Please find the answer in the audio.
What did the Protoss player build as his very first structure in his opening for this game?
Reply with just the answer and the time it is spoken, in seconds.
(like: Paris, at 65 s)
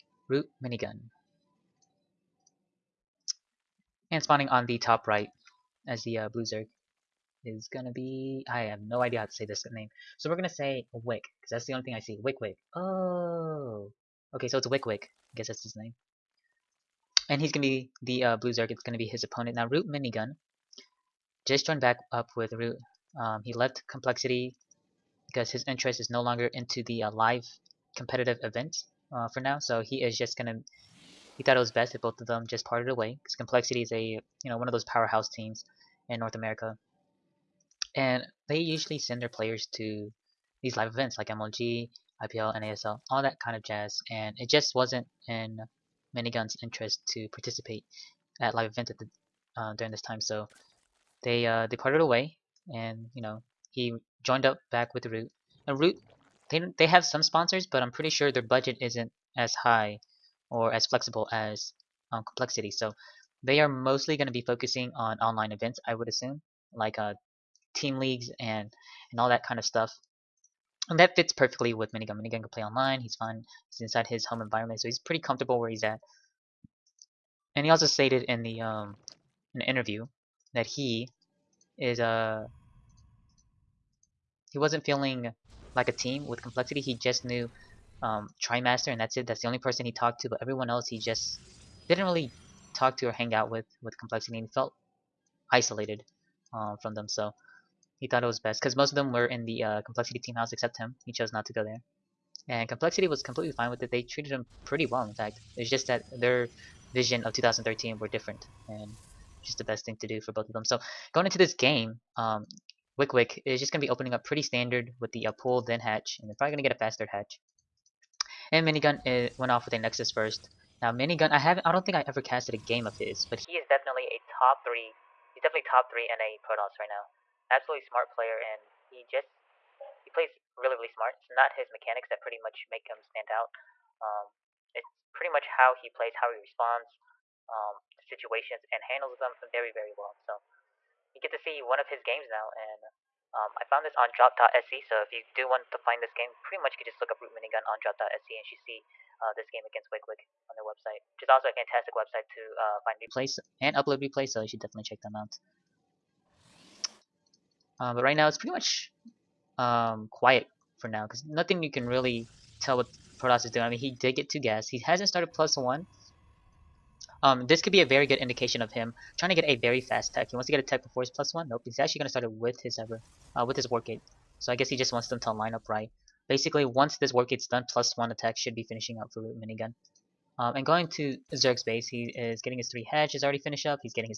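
Nexus, at 119 s.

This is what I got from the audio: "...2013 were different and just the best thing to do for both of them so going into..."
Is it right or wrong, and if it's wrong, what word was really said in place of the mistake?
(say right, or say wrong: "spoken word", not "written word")
right.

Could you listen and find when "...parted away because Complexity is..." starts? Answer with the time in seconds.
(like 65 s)
32 s.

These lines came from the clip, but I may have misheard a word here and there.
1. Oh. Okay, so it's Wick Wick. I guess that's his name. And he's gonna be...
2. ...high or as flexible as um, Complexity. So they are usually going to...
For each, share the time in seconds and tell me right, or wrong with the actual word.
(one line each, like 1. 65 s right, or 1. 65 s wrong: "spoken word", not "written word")
1. 12 s right
2. 59 s wrong: "mostly", not "usually".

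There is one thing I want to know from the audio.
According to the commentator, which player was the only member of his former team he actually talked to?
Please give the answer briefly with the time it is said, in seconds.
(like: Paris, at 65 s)
Trimaster, at 88 s.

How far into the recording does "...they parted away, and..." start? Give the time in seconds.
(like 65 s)
51 s.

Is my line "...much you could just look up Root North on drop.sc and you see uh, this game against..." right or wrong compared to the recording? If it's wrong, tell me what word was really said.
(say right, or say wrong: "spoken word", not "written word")
wrong: "Minigun", not "North".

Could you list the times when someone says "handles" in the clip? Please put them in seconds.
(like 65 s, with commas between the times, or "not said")
138 s.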